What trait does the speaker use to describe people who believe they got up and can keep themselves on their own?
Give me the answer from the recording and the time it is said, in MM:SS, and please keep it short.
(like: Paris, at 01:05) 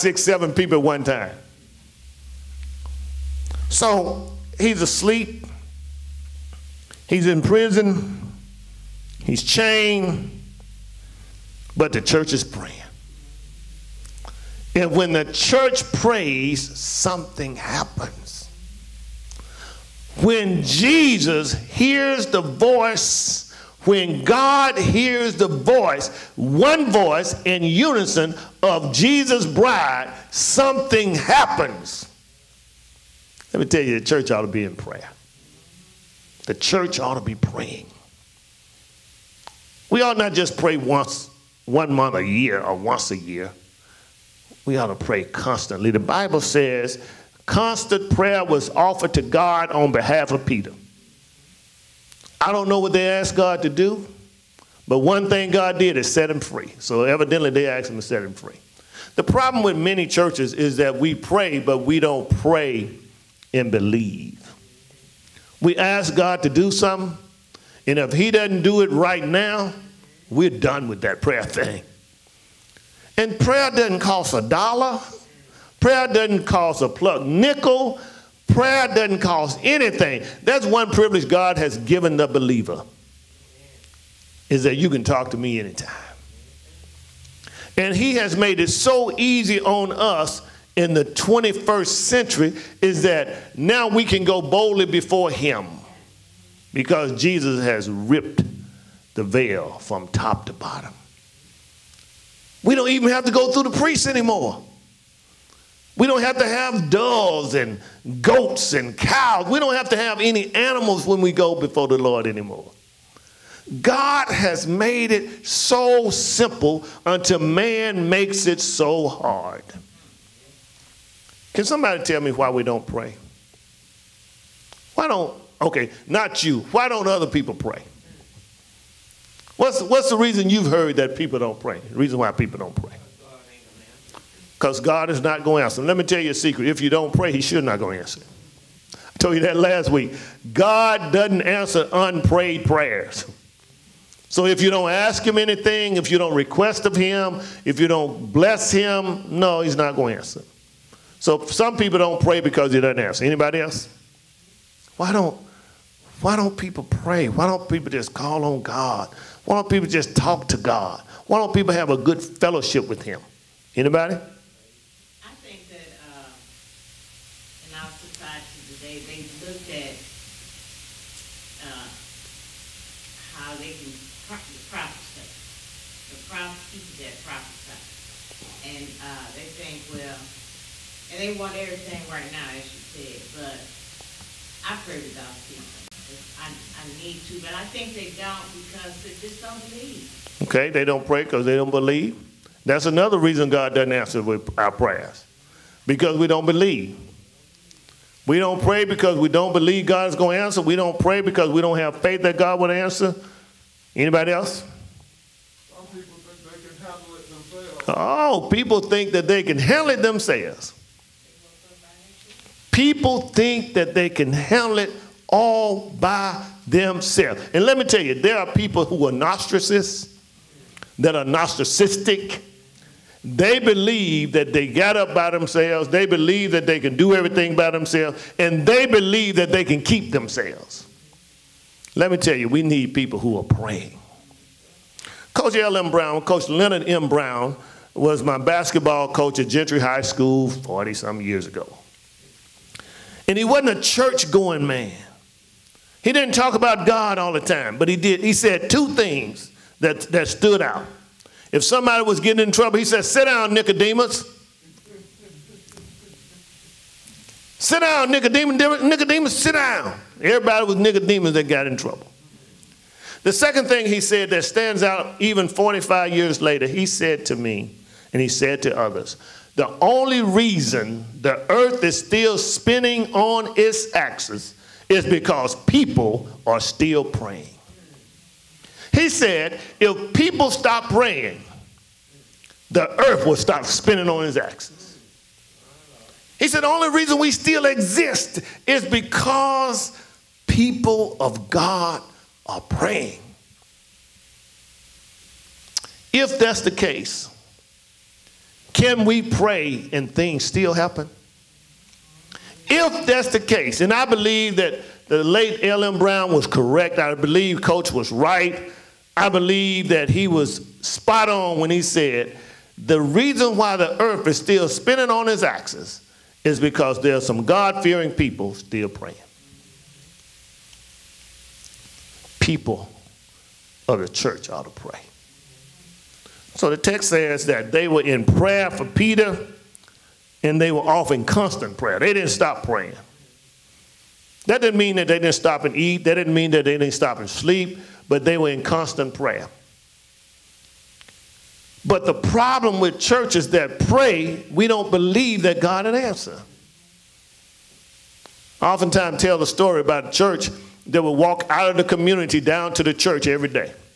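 narcissistic, at 03:41.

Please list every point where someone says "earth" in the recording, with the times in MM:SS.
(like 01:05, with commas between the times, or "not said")
04:31, 04:43, 05:14.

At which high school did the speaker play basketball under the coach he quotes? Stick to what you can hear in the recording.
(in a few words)
Gentry High School.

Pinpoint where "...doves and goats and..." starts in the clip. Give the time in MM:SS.
01:46.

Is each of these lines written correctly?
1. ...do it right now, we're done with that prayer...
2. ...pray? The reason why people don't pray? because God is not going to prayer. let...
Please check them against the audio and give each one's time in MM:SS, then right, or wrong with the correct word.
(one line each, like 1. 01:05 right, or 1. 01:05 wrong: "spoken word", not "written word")
1. 01:08 right
2. 02:11 wrong: "answer", not "prayer".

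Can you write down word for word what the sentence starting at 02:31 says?
So some people don't pray because he doesn't answer.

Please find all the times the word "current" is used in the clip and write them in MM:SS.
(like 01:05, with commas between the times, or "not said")
not said.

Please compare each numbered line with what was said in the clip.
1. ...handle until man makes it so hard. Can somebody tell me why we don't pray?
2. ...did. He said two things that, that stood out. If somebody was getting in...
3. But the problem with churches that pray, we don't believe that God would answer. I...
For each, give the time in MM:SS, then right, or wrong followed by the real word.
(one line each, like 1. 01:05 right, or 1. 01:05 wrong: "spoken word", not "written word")
1. 01:56 wrong: "simple", not "handle"
2. 04:07 right
3. 05:41 right.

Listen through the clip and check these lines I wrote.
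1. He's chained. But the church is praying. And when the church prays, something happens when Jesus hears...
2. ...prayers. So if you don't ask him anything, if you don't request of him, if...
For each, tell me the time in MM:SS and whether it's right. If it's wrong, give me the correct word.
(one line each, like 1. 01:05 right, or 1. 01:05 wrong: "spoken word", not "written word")
1. 00:09 right
2. 02:22 right.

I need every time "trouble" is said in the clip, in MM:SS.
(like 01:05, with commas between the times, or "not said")
04:12, 04:21.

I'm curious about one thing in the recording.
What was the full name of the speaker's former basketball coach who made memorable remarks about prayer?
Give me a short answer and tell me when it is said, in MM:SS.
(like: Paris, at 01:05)
Leonard M. Brown, at 03:56.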